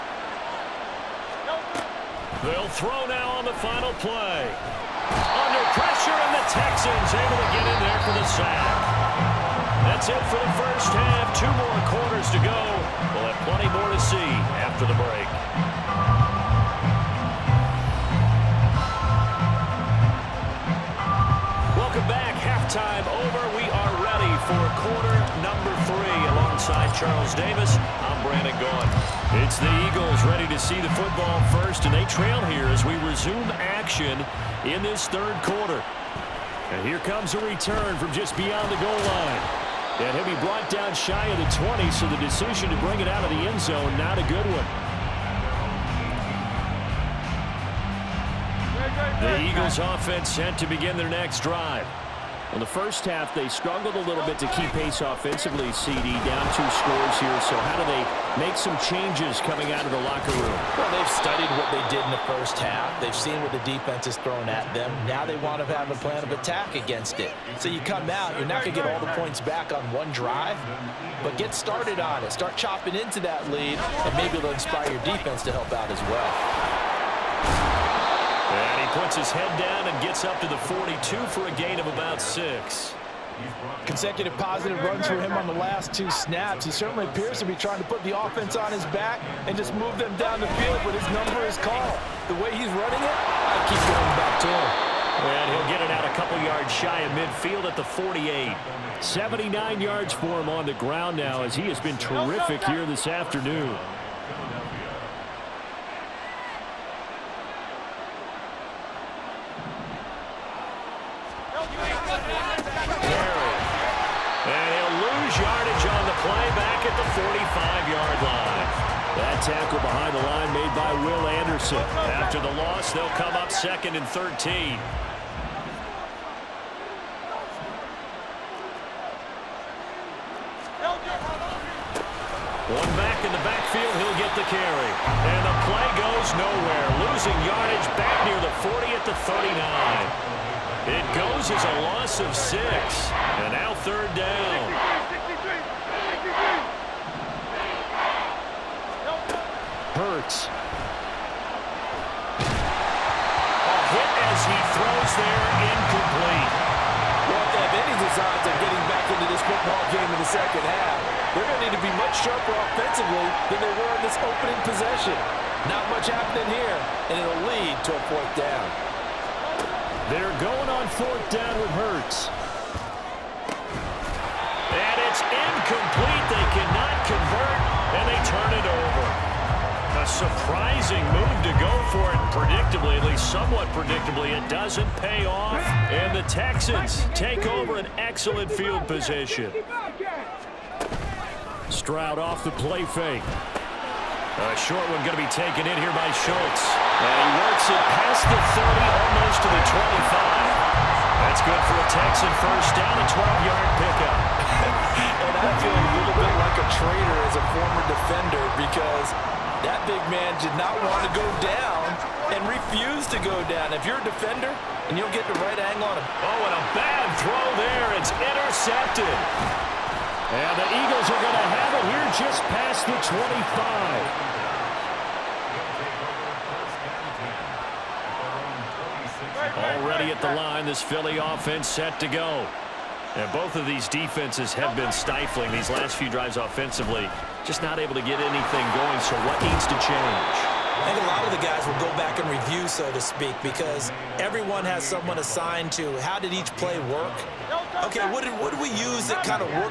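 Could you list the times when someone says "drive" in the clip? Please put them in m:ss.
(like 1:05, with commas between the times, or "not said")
0:51, 1:10, 3:56.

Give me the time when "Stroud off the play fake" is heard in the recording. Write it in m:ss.
3:11.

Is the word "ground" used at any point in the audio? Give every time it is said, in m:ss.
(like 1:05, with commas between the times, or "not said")
1:40.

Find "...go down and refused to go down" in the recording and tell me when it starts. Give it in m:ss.
3:31.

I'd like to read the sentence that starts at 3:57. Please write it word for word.
Just not able to get anything going, so what needs to change?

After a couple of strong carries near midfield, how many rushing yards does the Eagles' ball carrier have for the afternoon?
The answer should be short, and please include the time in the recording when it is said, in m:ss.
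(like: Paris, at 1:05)
79, at 1:39.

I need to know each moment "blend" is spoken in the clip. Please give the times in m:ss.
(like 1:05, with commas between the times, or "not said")
not said.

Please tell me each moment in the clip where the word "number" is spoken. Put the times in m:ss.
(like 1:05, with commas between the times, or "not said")
0:25, 1:31.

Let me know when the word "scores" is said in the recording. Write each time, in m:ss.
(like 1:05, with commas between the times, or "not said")
0:56.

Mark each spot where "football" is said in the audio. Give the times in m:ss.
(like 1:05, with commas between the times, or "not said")
0:30, 2:39.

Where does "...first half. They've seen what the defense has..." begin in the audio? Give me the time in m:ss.
1:02.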